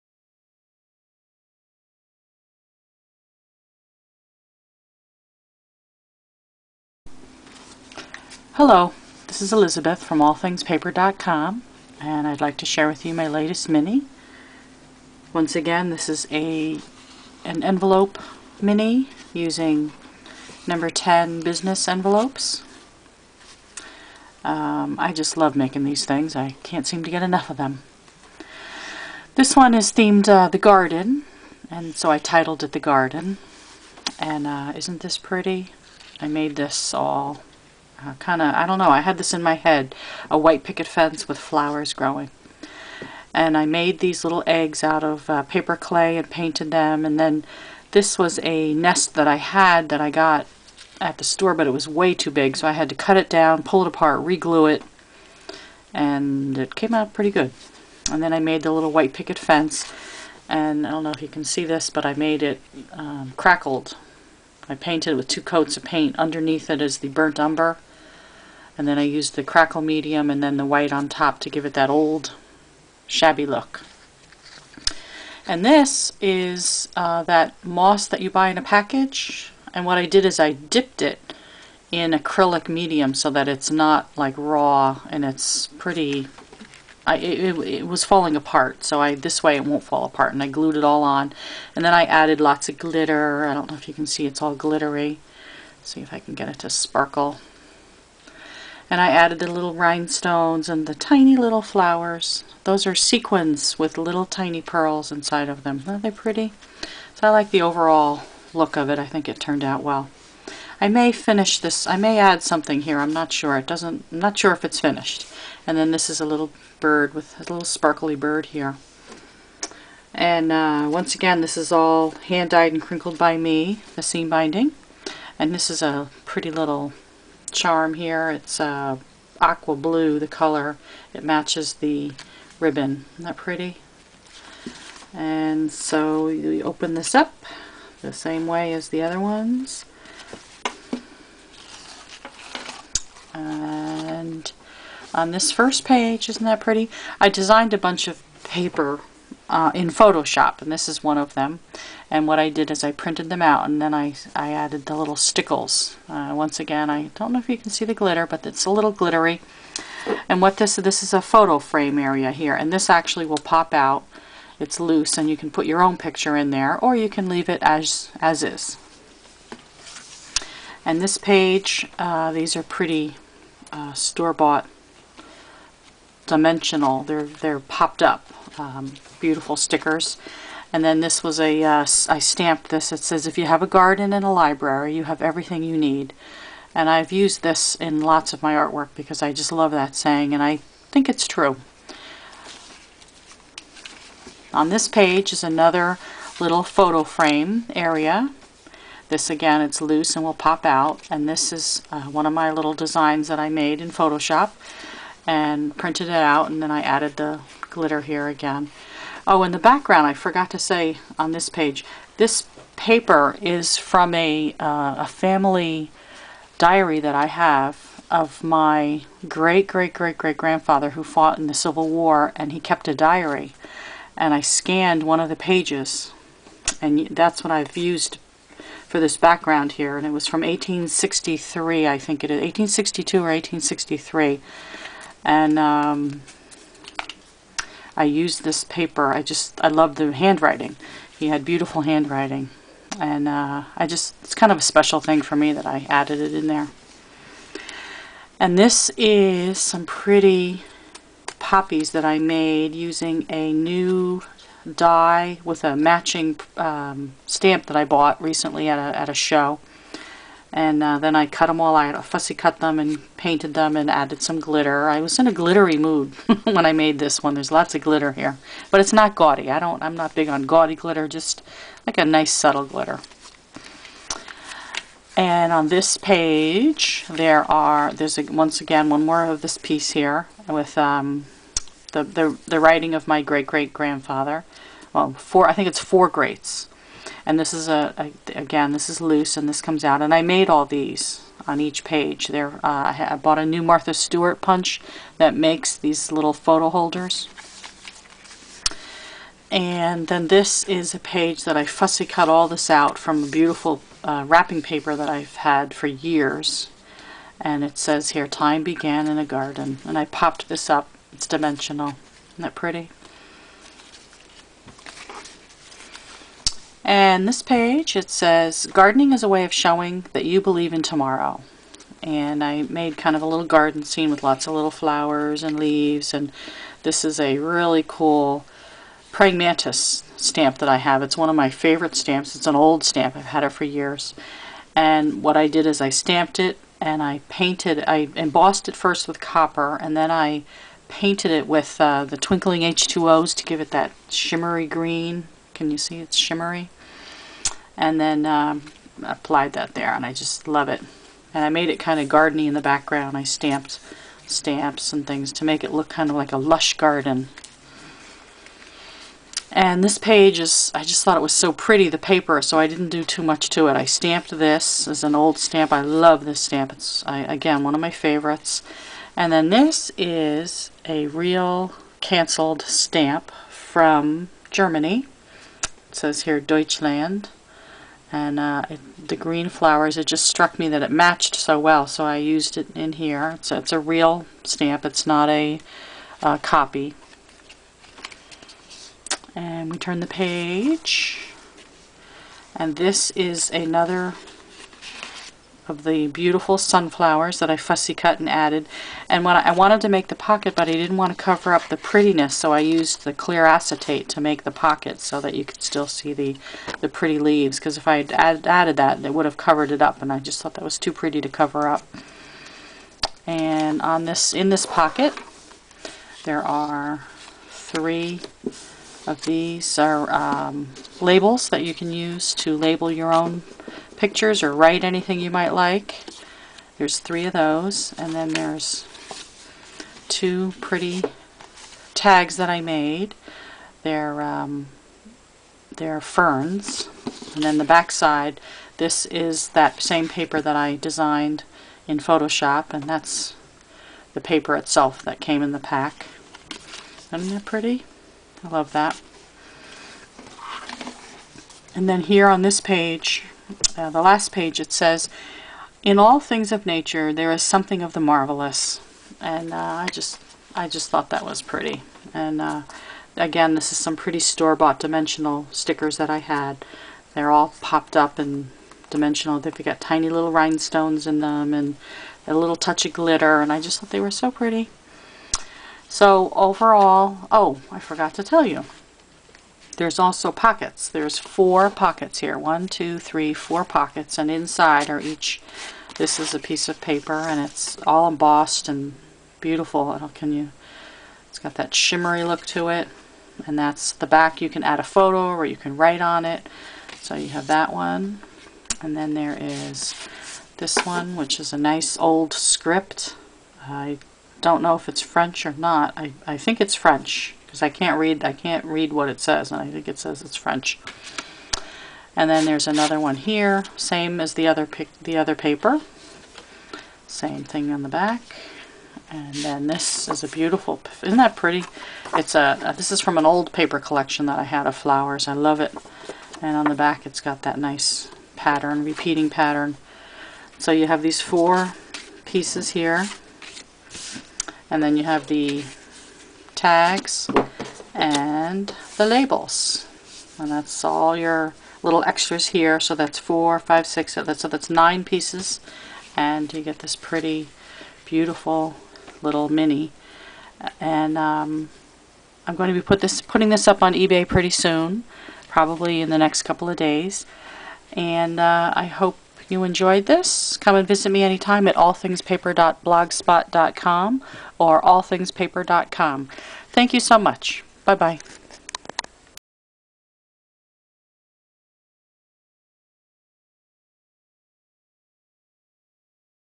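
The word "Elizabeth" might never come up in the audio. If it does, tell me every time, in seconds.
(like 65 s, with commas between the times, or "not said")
9 s.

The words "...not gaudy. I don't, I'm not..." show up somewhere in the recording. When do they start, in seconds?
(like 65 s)
268 s.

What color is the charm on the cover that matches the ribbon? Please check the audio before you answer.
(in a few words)
Aqua blue.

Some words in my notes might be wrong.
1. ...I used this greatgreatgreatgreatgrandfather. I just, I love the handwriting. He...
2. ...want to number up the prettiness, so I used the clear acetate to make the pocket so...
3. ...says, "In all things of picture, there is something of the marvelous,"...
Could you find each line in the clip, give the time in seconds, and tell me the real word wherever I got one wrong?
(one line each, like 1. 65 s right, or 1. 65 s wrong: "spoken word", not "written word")
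1. 237 s wrong: "paper", not "greatgreatgreatgreatgrandfather"
2. 400 s wrong: "cover", not "number"
3. 454 s wrong: "nature", not "picture".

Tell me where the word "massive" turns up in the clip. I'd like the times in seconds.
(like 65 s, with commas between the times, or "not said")
not said.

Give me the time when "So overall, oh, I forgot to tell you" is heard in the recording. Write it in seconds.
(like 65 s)
475 s.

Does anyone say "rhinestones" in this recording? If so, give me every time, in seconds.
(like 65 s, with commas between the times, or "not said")
99 s, 470 s.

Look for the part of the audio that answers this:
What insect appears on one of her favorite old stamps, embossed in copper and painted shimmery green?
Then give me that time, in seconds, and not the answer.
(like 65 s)
329 s.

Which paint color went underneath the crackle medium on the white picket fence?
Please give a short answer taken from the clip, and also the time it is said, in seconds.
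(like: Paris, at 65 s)
Burnt umber, at 67 s.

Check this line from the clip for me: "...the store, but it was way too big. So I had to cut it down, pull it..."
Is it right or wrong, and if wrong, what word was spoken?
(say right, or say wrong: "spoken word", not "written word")
right.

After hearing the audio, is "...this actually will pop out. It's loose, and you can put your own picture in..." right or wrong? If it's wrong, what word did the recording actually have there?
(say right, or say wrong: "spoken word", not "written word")
right.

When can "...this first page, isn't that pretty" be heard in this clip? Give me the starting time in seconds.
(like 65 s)
145 s.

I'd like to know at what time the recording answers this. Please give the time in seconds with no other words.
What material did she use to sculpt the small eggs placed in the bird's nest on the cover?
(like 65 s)
45 s.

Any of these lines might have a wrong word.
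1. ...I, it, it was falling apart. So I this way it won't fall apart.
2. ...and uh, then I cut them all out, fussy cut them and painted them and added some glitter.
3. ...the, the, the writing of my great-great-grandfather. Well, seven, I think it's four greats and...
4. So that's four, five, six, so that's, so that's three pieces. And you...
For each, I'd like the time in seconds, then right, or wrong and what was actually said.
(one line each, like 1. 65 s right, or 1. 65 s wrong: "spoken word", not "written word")
1. 87 s right
2. 260 s right
3. 281 s wrong: "four", not "seven"
4. 542 s wrong: "nine", not "three".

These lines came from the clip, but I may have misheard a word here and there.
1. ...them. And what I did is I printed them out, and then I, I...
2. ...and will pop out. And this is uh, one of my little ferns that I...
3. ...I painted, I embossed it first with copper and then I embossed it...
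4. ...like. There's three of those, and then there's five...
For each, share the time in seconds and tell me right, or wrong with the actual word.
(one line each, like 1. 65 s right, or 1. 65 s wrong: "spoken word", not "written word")
1. 151 s right
2. 200 s wrong: "designs", not "ferns"
3. 337 s wrong: "painted", not "embossed"
4. 425 s wrong: "two", not "five".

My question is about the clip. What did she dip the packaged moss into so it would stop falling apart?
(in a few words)
Acrylic medium.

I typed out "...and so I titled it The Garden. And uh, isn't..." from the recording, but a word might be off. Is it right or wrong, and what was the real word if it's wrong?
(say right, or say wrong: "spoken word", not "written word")
right.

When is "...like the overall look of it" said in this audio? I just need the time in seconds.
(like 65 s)
107 s.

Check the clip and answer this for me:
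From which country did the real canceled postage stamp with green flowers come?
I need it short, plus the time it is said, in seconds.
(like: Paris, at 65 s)
Germany, at 374 s.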